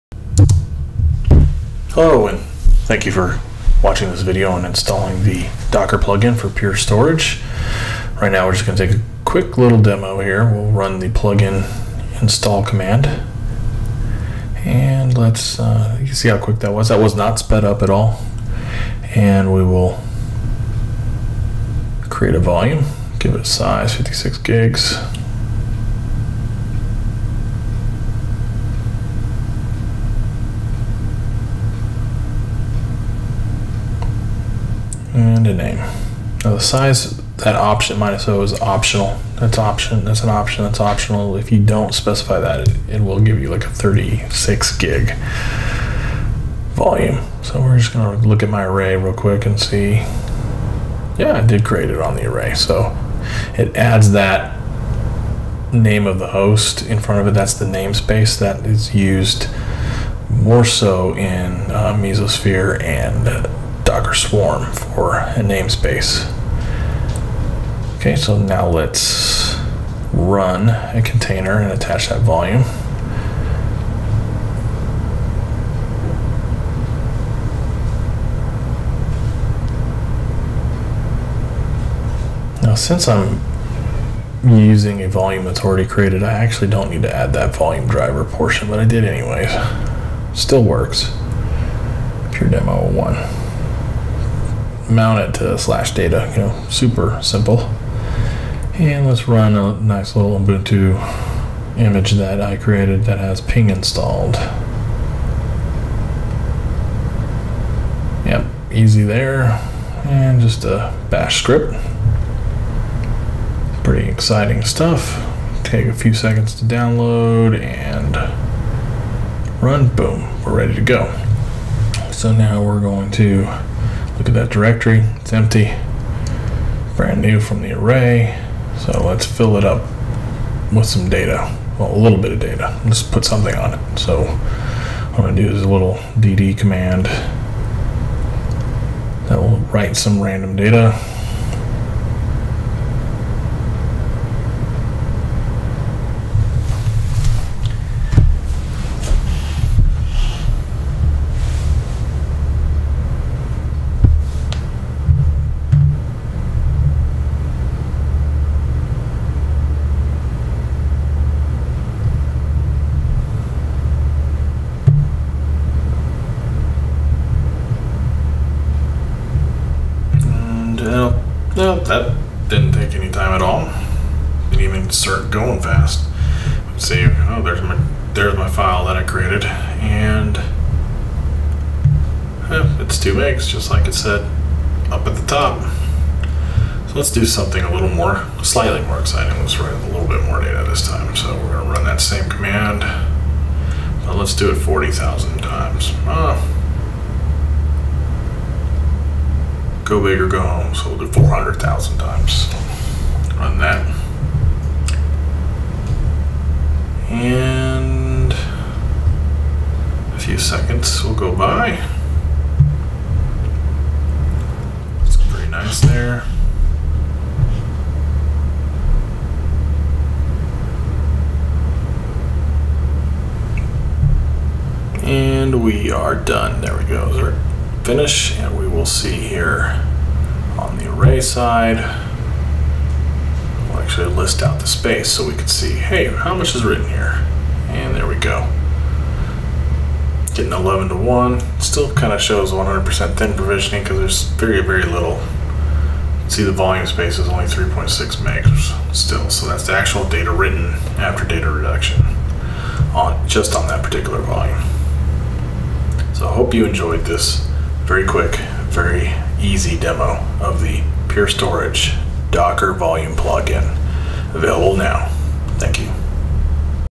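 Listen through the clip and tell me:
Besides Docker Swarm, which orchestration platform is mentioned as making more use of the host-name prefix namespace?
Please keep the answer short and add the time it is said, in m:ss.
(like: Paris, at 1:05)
Mesosphere, at 1:01.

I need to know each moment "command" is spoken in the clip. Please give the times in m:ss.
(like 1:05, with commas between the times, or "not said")
0:12, 2:16, 3:12.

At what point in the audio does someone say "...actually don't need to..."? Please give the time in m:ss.
1:26.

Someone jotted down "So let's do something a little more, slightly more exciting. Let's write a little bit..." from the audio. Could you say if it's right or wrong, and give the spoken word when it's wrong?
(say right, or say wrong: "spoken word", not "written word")
right.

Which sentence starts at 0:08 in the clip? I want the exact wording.
Right now, we're just going to take a quick little demo here.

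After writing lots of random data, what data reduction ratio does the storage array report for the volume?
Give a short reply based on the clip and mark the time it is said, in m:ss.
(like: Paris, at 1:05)
11 to 1, at 4:00.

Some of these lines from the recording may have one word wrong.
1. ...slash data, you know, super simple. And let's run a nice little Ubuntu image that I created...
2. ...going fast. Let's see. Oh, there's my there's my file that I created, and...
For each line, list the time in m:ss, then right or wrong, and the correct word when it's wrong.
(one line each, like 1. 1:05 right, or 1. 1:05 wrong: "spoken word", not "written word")
1. 1:35 right
2. 2:55 right.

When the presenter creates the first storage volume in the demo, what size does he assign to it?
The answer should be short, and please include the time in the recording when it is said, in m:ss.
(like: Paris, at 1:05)
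56 gigs, at 0:23.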